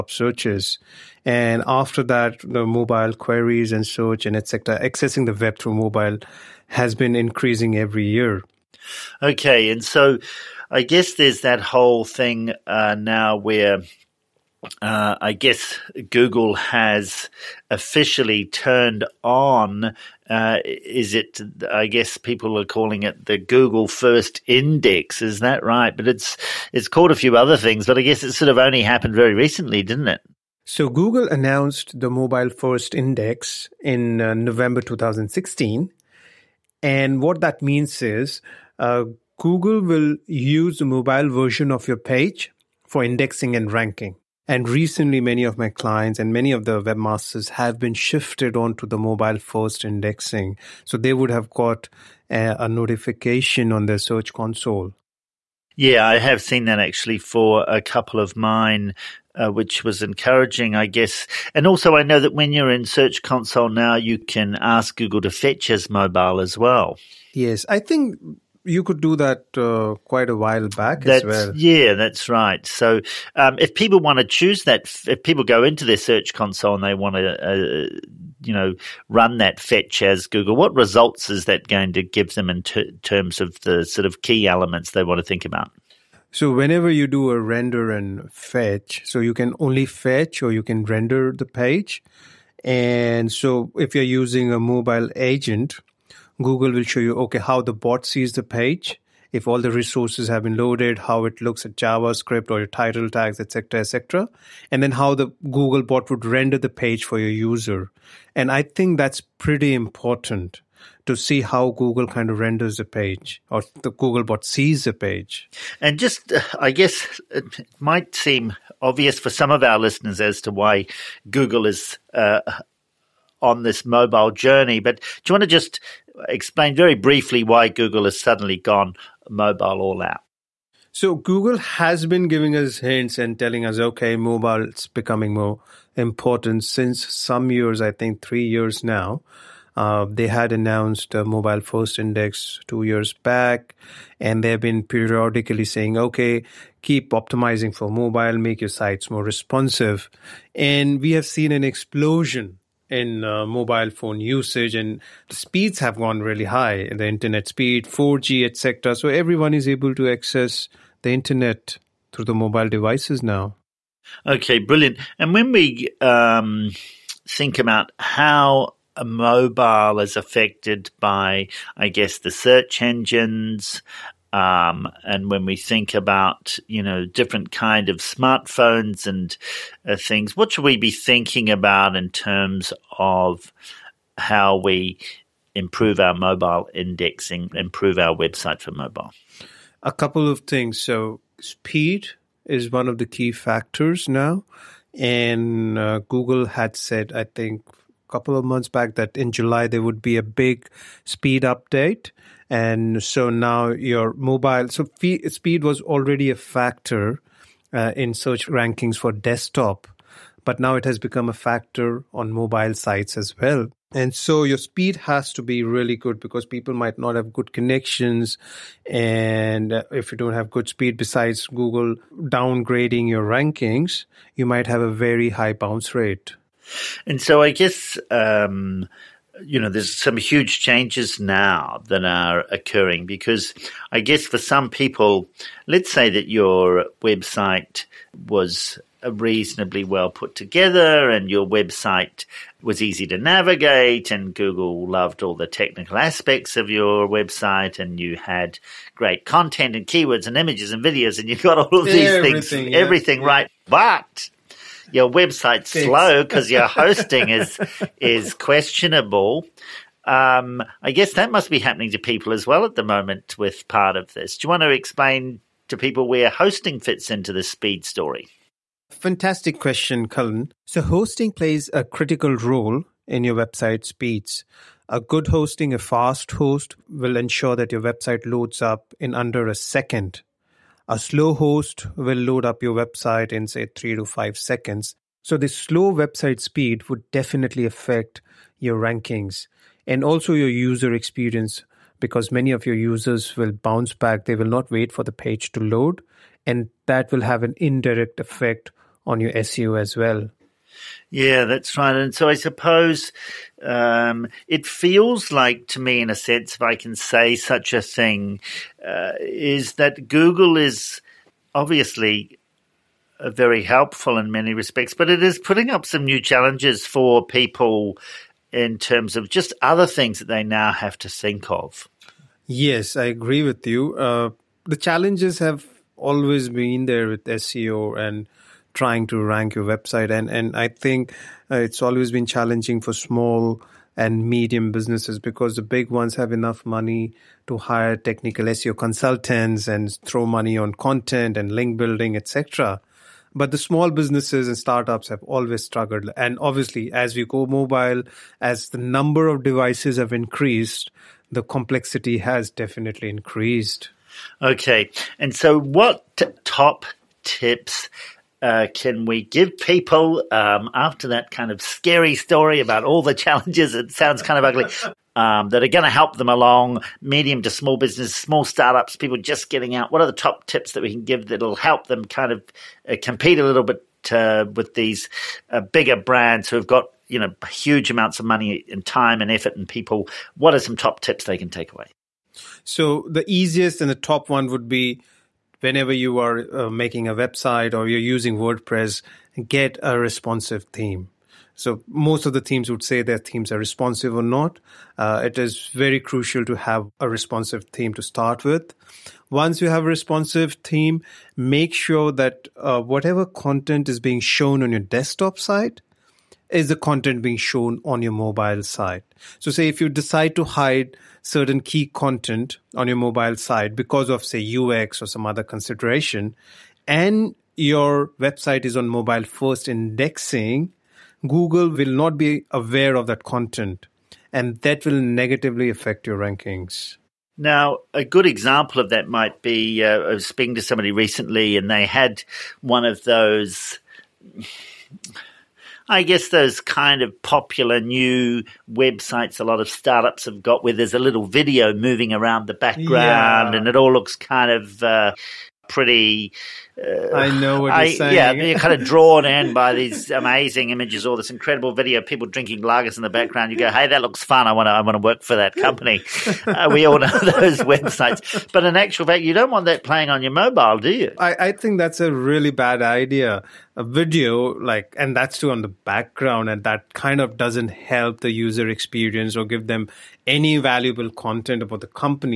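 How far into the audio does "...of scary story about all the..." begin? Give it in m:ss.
6:01.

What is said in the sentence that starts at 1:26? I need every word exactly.
So whenever you do a render and fetch, so you can only fetch or you can render the page.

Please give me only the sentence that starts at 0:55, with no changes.
Yeah, I have seen that actually for a couple of mine.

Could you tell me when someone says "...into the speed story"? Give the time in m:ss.
4:27.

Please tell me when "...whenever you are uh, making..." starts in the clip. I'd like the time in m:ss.
6:25.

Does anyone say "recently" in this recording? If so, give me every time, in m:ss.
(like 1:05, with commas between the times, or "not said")
0:29, 0:44, 7:10.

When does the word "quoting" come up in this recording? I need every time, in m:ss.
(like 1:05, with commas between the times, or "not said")
not said.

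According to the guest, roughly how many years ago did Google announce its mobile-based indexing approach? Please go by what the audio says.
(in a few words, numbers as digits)
2 years.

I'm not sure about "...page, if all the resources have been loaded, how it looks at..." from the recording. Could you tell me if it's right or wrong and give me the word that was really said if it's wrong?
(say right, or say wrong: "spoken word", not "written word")
right.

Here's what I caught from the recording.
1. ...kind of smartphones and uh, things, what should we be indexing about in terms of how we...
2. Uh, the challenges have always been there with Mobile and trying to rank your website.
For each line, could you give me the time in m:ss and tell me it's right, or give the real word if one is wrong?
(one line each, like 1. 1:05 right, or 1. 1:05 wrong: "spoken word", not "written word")
1. 2:57 wrong: "thinking", not "indexing"
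2. 5:23 wrong: "SEO", not "Mobile".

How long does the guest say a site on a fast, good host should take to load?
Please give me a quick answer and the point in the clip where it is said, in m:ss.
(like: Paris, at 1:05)
under a second, at 4:39.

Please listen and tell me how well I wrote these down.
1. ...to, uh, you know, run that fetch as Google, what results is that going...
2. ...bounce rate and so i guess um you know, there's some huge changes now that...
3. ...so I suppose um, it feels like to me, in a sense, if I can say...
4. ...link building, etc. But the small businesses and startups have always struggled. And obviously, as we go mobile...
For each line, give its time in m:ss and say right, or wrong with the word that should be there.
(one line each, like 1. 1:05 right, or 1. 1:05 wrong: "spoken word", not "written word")
1. 1:17 right
2. 3:45 right
3. 5:02 right
4. 5:41 right.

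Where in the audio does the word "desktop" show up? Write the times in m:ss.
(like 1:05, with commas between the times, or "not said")
3:29, 6:44.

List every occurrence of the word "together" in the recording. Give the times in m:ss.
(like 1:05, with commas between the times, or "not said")
4:00.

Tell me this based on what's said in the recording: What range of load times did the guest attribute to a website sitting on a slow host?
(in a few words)
3 to 5 seconds.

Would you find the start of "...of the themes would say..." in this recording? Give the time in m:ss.
6:32.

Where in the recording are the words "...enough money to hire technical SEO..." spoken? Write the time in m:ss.
5:36.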